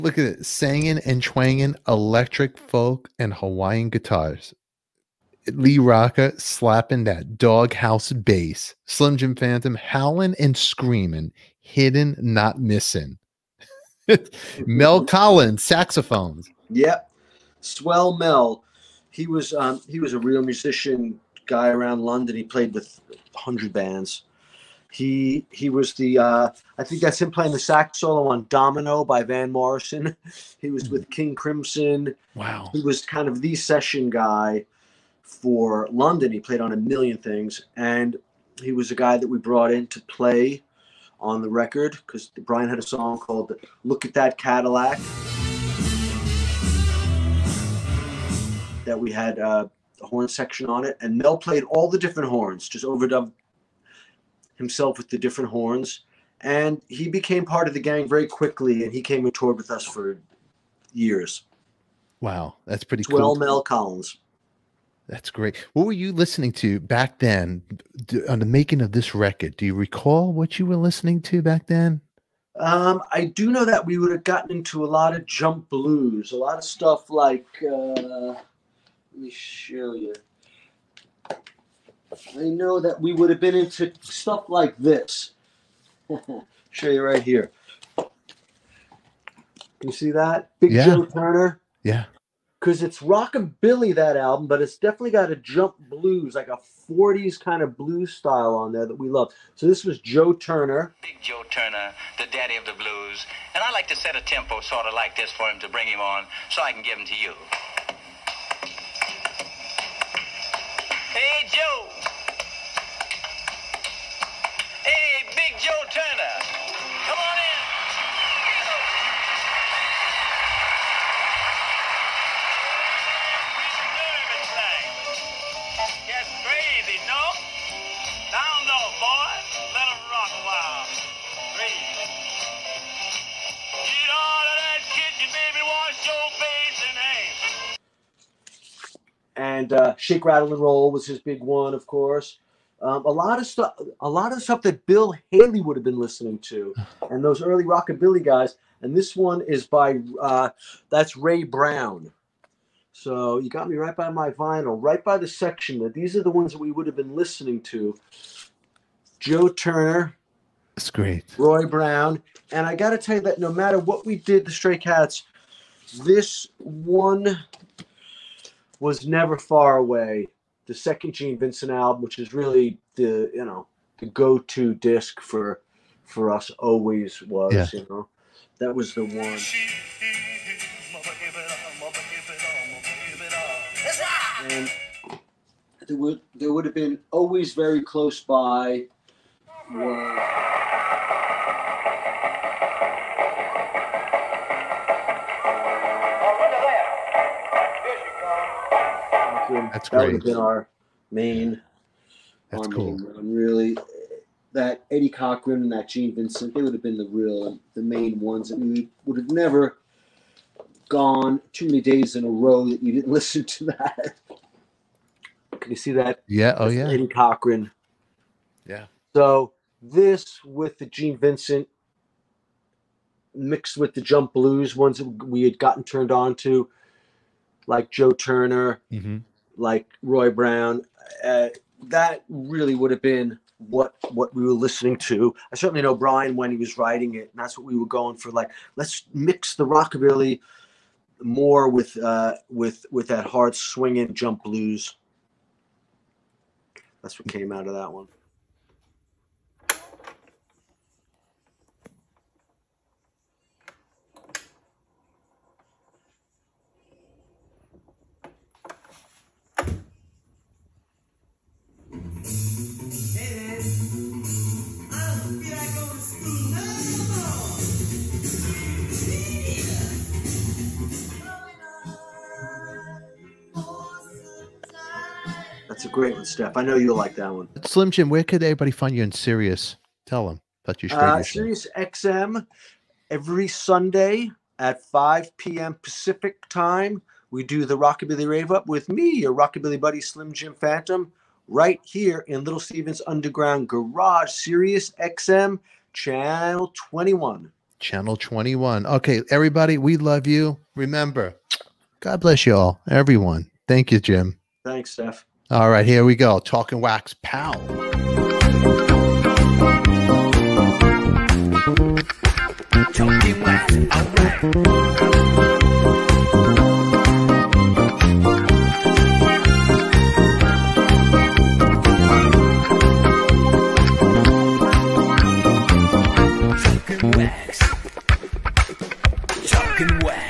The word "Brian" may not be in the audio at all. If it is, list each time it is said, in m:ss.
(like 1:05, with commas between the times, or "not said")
0:42, 3:55.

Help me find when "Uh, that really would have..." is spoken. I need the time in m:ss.
3:51.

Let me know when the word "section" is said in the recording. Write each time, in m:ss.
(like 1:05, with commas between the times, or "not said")
0:50, 2:35.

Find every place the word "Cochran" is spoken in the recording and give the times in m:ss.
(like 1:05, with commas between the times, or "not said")
3:25, 3:37.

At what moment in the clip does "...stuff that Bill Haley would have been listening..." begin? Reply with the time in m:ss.
2:24.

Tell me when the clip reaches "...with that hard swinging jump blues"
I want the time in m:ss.
4:02.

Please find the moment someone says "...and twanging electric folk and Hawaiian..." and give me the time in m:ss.
0:01.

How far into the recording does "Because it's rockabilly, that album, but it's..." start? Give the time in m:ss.
1:32.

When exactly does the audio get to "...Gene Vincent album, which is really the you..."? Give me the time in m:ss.
2:51.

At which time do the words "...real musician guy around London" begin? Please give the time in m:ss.
0:20.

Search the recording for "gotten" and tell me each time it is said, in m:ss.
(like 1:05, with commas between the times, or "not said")
1:14, 3:45.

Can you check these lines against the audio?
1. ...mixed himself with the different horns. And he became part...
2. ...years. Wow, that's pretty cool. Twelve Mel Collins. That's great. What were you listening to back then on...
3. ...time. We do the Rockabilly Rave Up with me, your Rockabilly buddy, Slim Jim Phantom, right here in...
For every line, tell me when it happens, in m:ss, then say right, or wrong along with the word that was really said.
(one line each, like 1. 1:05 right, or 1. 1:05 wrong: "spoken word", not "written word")
1. 0:52 wrong: "overdubbed", not "mixed"
2. 1:00 right
3. 4:46 right.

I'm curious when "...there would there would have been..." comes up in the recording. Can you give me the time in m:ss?
3:05.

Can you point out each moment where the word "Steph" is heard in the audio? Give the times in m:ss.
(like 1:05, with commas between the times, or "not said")
4:36, 5:04.